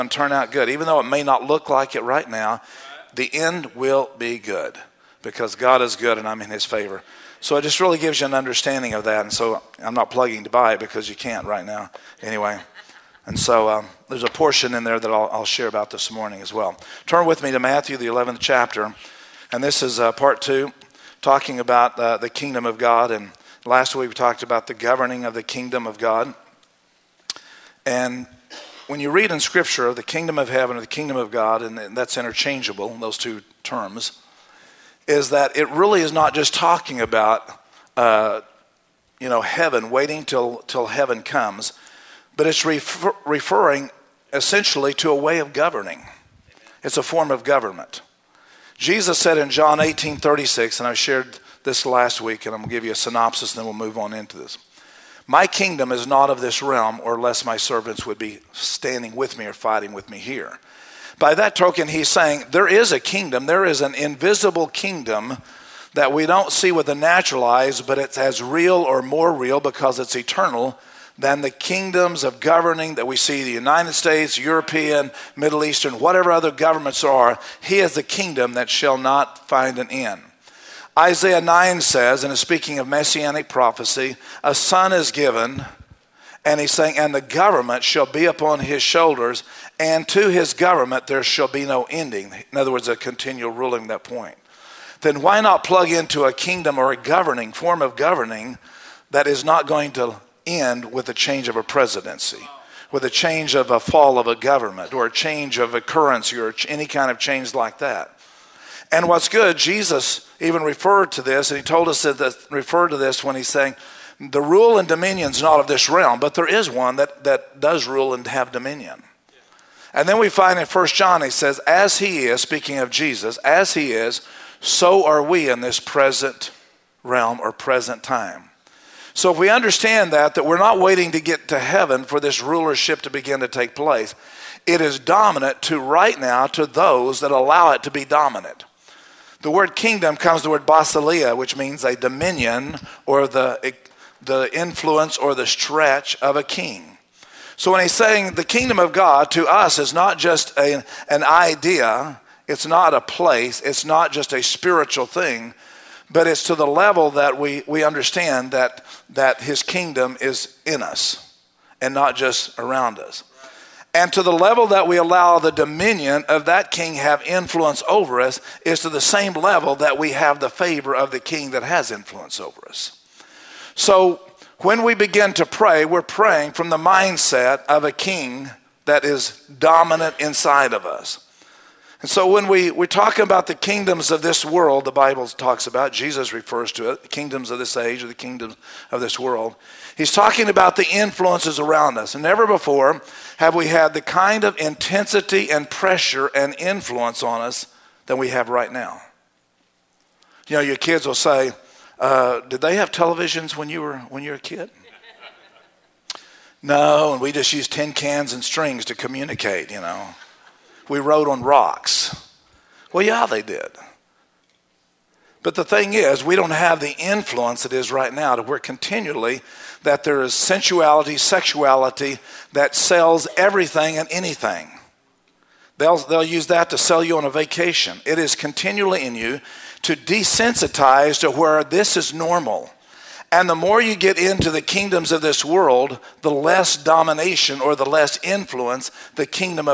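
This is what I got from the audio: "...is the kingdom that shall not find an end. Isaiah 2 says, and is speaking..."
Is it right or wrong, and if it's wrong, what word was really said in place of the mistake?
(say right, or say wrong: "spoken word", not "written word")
wrong: "9", not "2".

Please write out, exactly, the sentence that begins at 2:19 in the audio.
The word kingdom comes the word basileia, which means a dominion or the, the influence or the stretch of a king.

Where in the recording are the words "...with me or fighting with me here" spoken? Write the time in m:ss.
0:59.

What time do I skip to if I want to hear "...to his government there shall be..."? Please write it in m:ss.
1:30.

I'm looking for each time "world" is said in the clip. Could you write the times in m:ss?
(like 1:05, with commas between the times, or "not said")
3:04, 3:09, 3:55.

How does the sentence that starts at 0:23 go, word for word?
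And last week we talked about the governing of the kingdom of God.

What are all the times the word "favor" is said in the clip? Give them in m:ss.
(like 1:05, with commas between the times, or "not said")
0:06, 2:50.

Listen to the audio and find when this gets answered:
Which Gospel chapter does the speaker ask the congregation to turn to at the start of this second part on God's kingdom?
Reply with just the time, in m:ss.
0:17.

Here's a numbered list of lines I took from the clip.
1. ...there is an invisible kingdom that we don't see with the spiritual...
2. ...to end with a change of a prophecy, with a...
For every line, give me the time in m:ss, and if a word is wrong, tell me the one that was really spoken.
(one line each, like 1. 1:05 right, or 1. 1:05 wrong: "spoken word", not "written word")
1. 1:03 wrong: "natural", not "spiritual"
2. 1:39 wrong: "presidency", not "prophecy".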